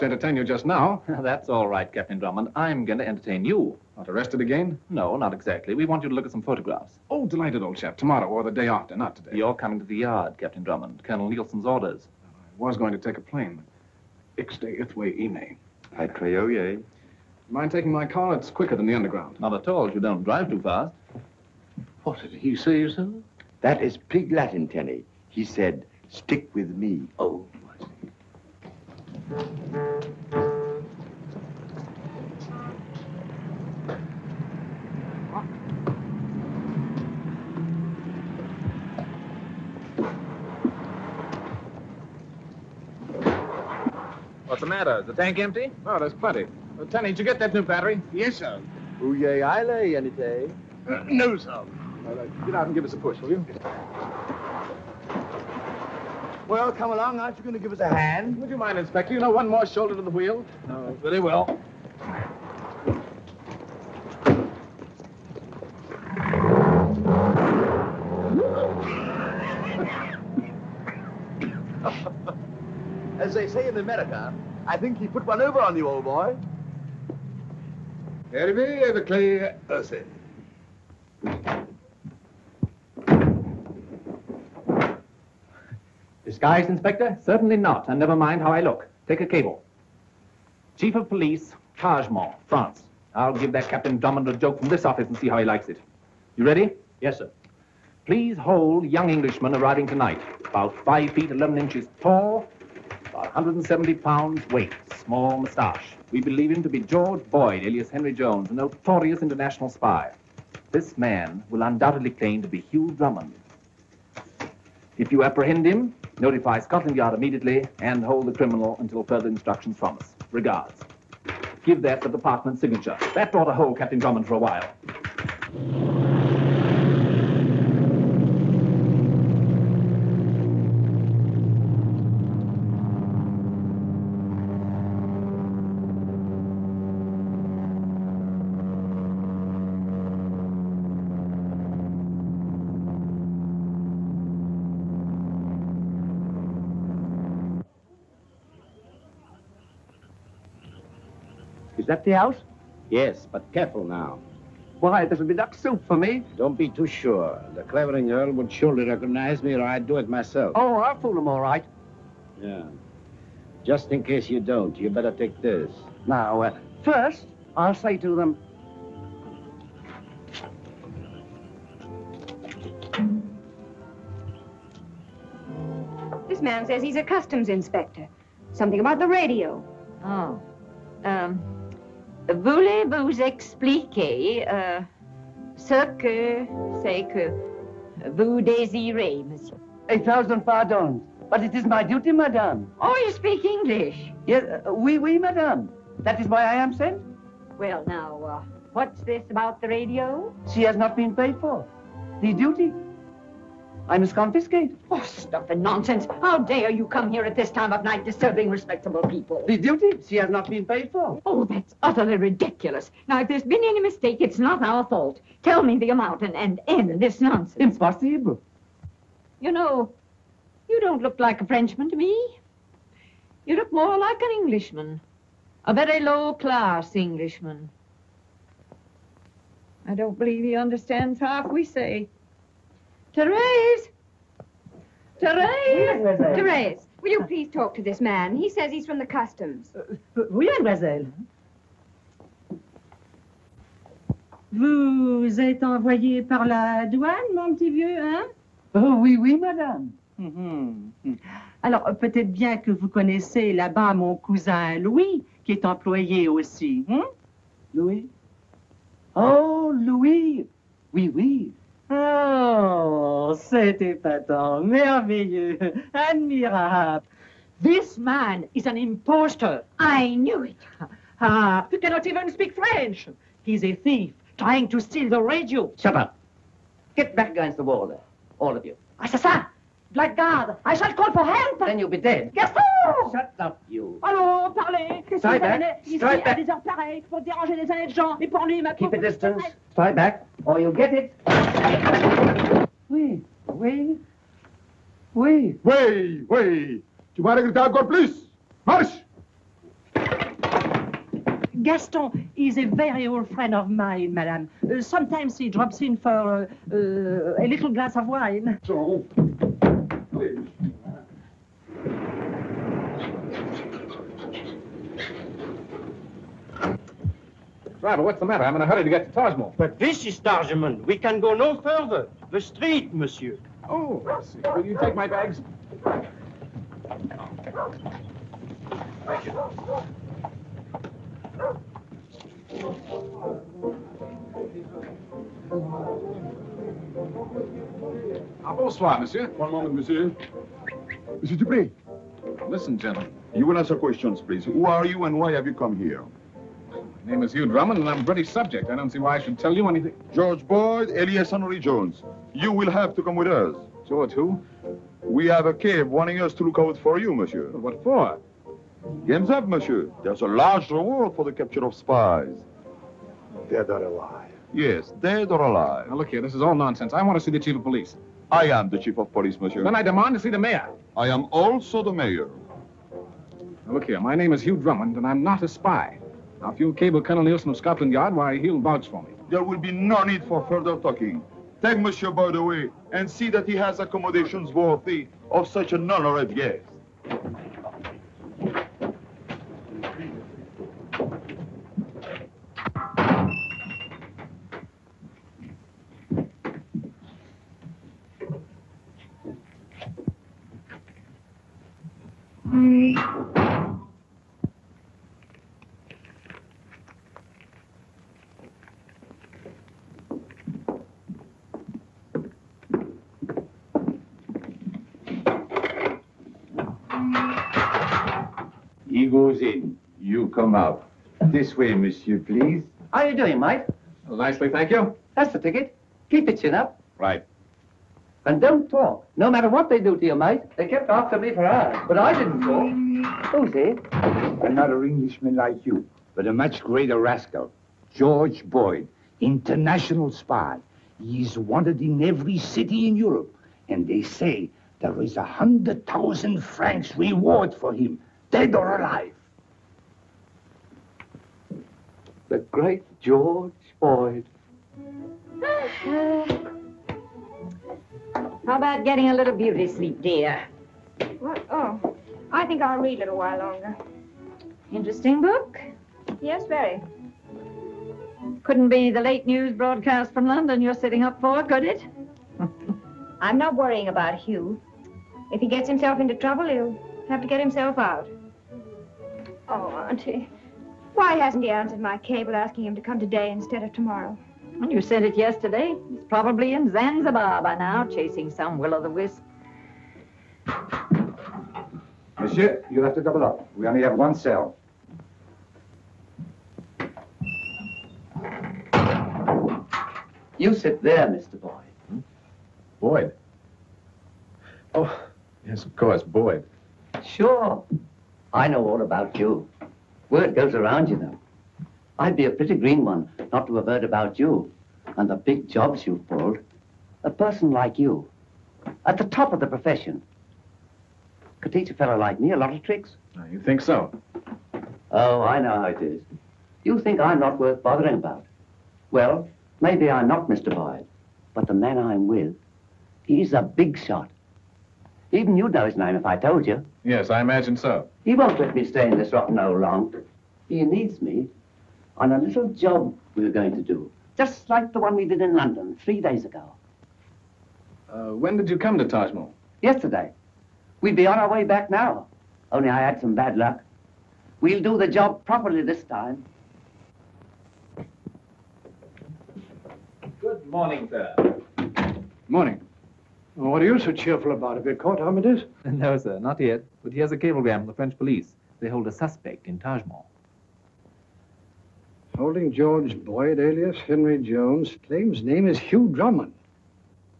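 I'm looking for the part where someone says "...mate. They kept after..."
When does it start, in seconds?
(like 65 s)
430 s.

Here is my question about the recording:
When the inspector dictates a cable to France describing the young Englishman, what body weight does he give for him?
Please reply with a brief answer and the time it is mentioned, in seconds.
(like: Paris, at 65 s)
170 pounds, at 103 s.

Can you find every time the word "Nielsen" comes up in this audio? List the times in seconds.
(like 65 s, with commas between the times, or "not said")
11 s, 377 s.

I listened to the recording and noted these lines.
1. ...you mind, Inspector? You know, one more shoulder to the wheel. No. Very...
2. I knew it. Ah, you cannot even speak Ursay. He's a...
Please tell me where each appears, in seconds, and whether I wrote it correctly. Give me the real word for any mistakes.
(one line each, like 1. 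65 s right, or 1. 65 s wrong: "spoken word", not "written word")
1. 58 s right
2. 269 s wrong: "French", not "Ursay".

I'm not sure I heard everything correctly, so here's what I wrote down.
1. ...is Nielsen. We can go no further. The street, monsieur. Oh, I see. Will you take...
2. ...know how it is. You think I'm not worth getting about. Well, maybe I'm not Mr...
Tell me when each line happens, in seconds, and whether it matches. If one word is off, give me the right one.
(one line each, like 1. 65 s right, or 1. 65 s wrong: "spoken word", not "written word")
1. 320 s wrong: "Tarjman", not "Nielsen"
2. 525 s wrong: "bothering", not "getting".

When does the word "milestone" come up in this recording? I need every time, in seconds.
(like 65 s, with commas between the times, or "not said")
not said.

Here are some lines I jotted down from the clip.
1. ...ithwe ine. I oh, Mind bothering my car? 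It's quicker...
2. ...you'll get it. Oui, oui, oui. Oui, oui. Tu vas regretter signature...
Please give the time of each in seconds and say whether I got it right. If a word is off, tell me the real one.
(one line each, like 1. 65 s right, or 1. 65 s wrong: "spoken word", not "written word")
1. 14 s wrong: "taking", not "bothering"
2. 290 s wrong: "encore", not "signature".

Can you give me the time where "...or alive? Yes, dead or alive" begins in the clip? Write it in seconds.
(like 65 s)
363 s.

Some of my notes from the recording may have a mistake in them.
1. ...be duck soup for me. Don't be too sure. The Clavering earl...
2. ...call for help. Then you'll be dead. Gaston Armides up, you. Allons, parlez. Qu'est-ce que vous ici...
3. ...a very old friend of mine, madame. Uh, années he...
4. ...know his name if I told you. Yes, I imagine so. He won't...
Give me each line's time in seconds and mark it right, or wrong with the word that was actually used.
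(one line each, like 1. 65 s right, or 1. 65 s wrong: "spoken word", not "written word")
1. 155 s right
2. 280 s wrong: "Shut", not "Armides"
3. 302 s wrong: "sometimes", not "années"
4. 535 s right.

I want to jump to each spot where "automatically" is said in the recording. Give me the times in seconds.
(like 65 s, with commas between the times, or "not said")
not said.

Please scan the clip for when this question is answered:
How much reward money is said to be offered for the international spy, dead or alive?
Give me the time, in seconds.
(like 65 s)
445 s.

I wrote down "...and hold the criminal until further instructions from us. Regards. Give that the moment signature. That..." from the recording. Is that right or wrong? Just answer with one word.
wrong.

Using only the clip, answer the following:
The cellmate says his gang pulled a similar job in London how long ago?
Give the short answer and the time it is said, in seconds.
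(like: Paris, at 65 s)
3 days ago, at 545 s.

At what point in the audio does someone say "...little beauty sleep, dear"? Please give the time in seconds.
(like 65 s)
459 s.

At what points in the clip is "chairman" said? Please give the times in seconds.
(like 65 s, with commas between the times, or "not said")
not said.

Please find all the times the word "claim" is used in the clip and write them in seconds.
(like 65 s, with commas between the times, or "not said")
112 s, 574 s.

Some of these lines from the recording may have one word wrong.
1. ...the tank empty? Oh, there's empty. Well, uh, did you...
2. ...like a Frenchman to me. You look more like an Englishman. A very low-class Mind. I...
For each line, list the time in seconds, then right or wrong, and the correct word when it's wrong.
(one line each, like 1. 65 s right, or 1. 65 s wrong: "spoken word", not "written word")
1. 45 s wrong: "plenty", not "empty"
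2. 221 s wrong: "Englishman", not "Mind".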